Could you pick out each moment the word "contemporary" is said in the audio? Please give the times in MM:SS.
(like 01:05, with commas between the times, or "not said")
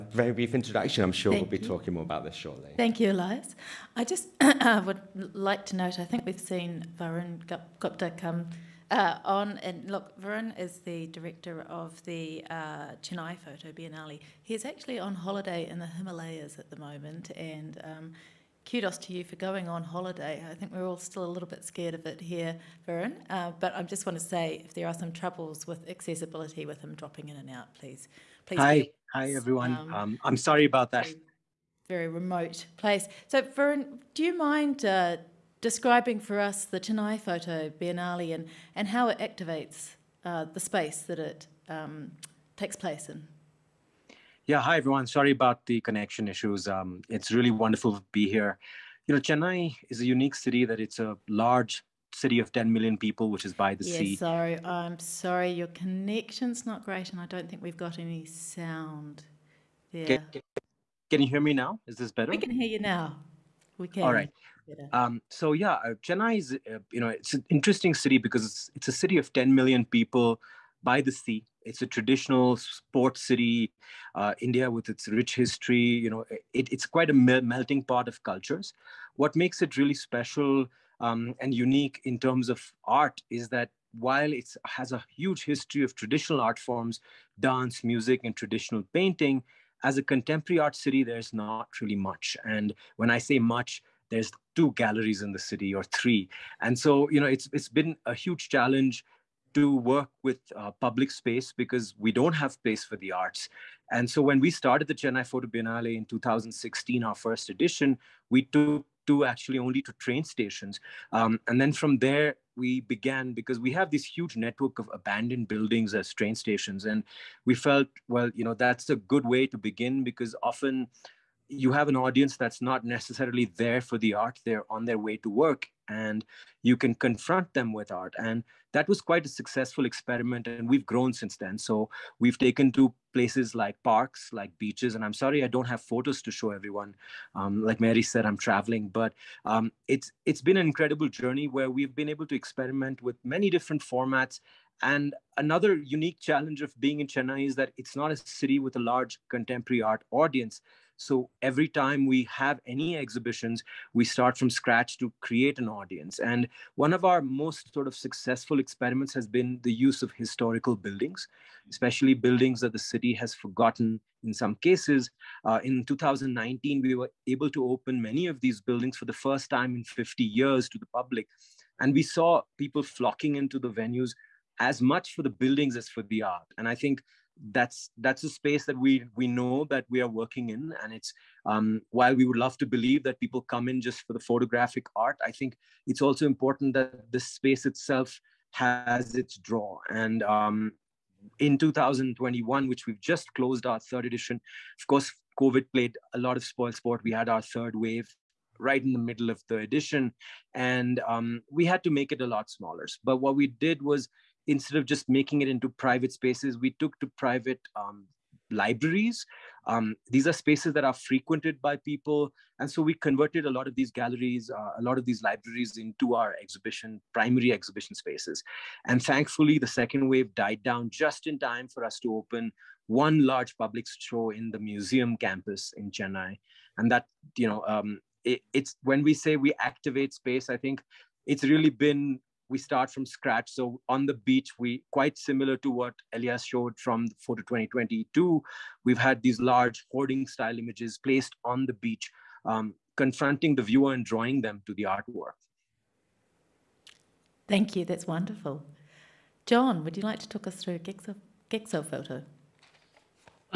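01:30, 02:29.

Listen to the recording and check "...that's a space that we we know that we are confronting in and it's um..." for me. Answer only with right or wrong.
wrong.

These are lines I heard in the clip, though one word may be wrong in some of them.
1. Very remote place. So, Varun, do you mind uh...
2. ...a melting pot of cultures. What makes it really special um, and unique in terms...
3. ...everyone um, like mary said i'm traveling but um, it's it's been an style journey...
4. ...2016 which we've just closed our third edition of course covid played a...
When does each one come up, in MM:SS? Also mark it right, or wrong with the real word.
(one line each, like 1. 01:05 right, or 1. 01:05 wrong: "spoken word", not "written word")
1. 00:31 right
2. 01:17 right
3. 02:16 wrong: "incredible", not "style"
4. 03:11 wrong: "2021", not "2016".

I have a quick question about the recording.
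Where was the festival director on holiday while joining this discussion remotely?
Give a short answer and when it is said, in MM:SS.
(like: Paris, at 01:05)
The Himalayas, at 00:15.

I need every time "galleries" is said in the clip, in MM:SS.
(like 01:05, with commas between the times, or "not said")
01:34, 03:33.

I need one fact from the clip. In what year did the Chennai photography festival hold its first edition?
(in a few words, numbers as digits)
2016.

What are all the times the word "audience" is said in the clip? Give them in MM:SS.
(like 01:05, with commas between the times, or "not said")
02:01, 02:30, 02:35.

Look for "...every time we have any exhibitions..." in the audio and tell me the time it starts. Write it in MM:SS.
02:31.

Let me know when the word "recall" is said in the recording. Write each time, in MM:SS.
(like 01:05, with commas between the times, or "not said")
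not said.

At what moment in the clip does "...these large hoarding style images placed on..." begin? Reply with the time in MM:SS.
03:59.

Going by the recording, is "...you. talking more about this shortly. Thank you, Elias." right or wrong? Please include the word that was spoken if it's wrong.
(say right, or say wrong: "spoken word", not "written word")
right.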